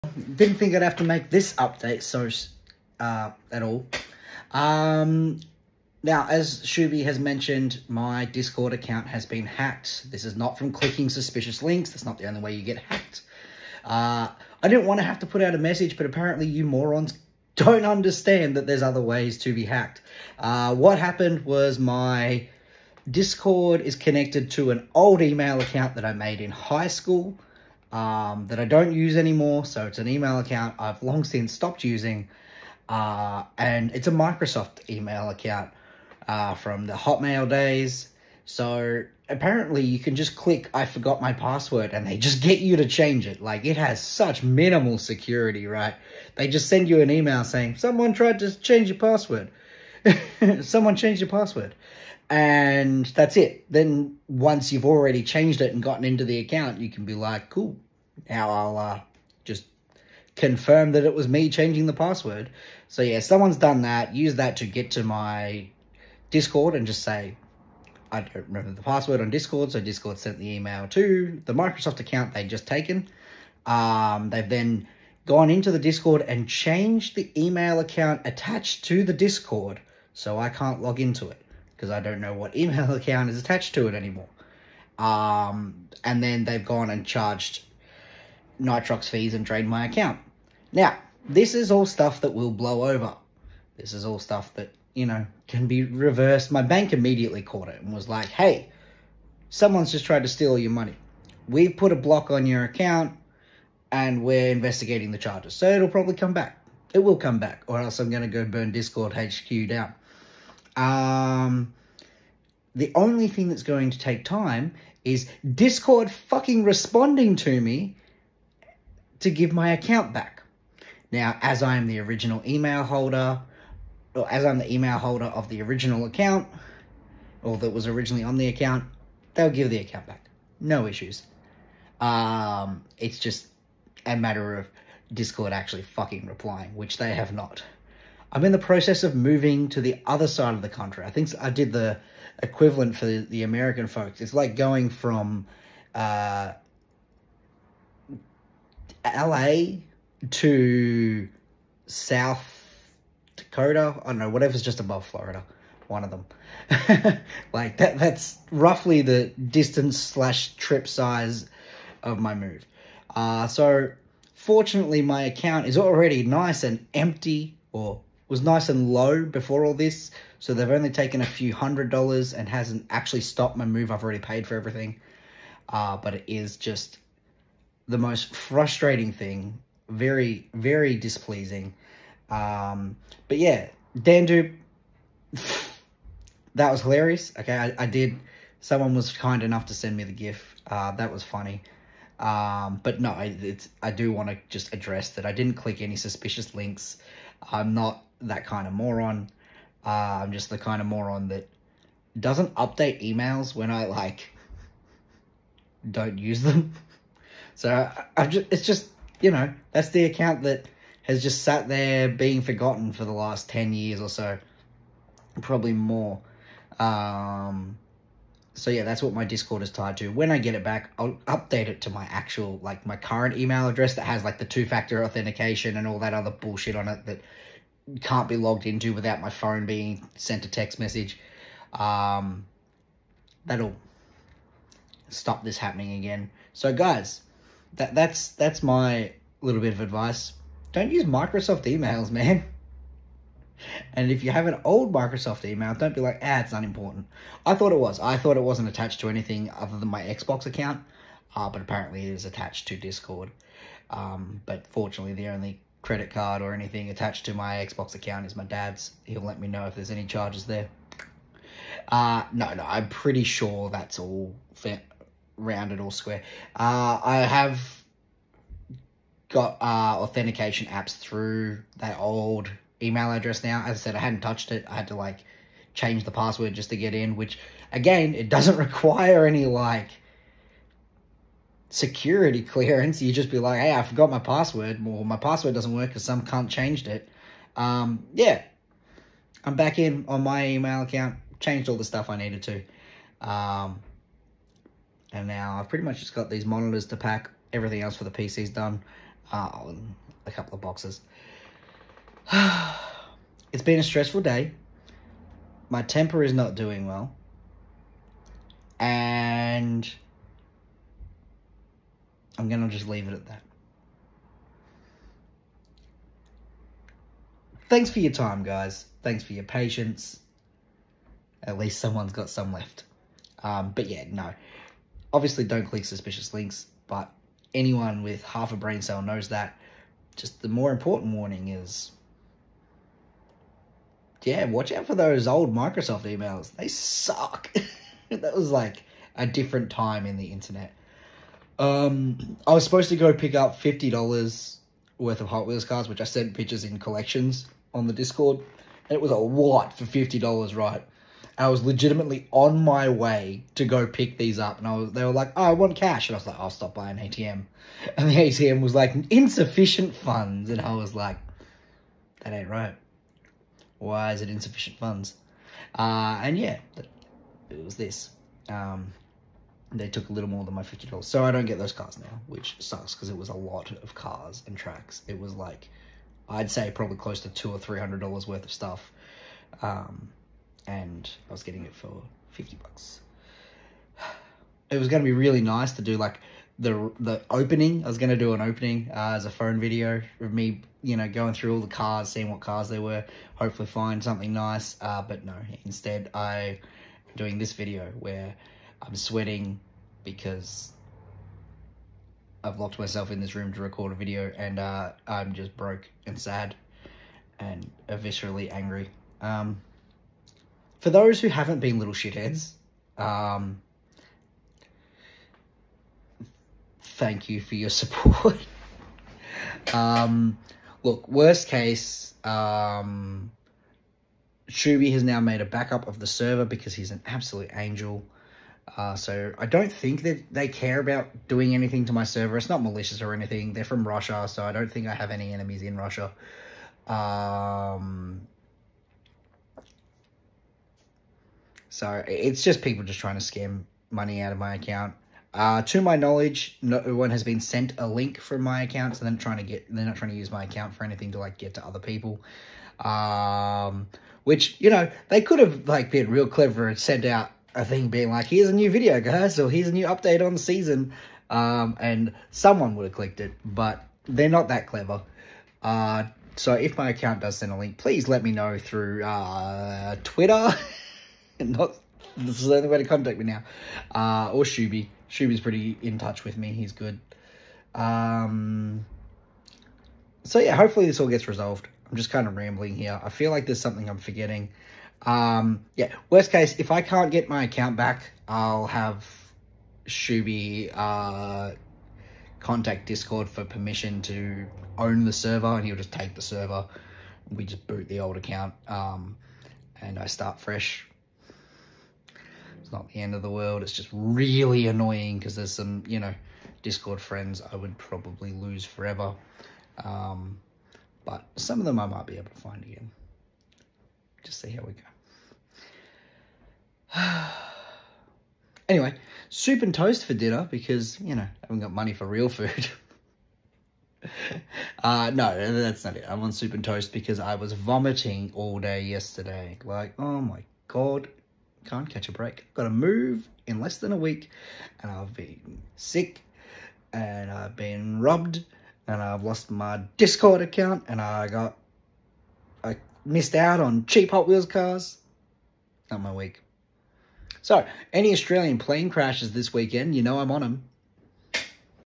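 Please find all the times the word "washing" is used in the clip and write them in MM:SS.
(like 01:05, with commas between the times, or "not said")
not said.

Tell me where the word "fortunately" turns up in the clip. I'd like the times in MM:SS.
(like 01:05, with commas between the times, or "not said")
02:44, 04:14.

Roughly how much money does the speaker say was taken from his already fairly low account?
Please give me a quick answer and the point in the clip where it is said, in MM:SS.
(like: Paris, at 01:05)
a few hundred dollars, at 02:51.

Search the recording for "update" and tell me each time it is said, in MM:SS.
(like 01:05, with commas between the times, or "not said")
00:01, 03:22, 03:41, 07:39.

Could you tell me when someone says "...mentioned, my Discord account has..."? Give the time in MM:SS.
00:07.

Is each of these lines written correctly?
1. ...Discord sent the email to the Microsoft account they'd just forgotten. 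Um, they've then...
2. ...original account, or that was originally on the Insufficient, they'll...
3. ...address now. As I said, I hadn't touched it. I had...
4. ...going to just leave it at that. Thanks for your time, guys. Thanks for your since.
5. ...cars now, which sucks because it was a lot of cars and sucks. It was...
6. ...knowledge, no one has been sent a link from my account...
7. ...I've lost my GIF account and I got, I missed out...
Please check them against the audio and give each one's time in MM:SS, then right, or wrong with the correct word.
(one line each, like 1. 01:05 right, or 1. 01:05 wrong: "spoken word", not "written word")
1. 01:09 wrong: "taken", not "forgotten"
2. 02:05 wrong: "account", not "Insufficient"
3. 04:33 right
4. 05:12 wrong: "patience", not "since"
5. 06:11 wrong: "tracks", not "sucks"
6. 07:25 right
7. 08:59 wrong: "Discord", not "GIF".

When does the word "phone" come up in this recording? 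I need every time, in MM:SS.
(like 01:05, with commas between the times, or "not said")
03:49, 06:29.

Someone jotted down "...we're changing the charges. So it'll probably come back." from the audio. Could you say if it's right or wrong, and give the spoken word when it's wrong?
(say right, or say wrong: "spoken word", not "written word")
wrong: "investigating", not "changing".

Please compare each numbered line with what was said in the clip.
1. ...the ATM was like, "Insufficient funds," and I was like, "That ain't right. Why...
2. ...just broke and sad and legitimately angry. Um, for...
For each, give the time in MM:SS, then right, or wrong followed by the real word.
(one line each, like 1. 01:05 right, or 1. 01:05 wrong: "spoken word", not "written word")
1. 05:58 right
2. 06:45 wrong: "viscerally", not "legitimately".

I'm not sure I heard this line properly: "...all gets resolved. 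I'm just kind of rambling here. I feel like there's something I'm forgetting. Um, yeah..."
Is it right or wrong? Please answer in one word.
right.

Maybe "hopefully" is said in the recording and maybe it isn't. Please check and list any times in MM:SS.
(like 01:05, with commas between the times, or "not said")
06:33, 08:00.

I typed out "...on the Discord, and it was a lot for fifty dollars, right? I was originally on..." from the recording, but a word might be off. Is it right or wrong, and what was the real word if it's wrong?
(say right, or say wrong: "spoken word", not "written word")
wrong: "legitimately", not "originally".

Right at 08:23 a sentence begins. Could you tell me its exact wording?
It's just really annoying because there's some, you know, Discord friends I would probably lose forever.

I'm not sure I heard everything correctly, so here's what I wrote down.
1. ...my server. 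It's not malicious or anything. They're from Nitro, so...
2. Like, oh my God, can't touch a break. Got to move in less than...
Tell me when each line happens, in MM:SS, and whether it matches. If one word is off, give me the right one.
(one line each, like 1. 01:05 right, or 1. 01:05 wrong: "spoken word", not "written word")
1. 07:11 wrong: "Russia", not "Nitro"
2. 08:49 wrong: "catch", not "touch".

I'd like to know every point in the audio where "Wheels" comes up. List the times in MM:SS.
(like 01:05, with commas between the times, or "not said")
05:45, 09:04.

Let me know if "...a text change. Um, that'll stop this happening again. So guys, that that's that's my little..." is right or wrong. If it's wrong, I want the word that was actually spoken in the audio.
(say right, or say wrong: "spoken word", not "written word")
wrong: "message", not "change".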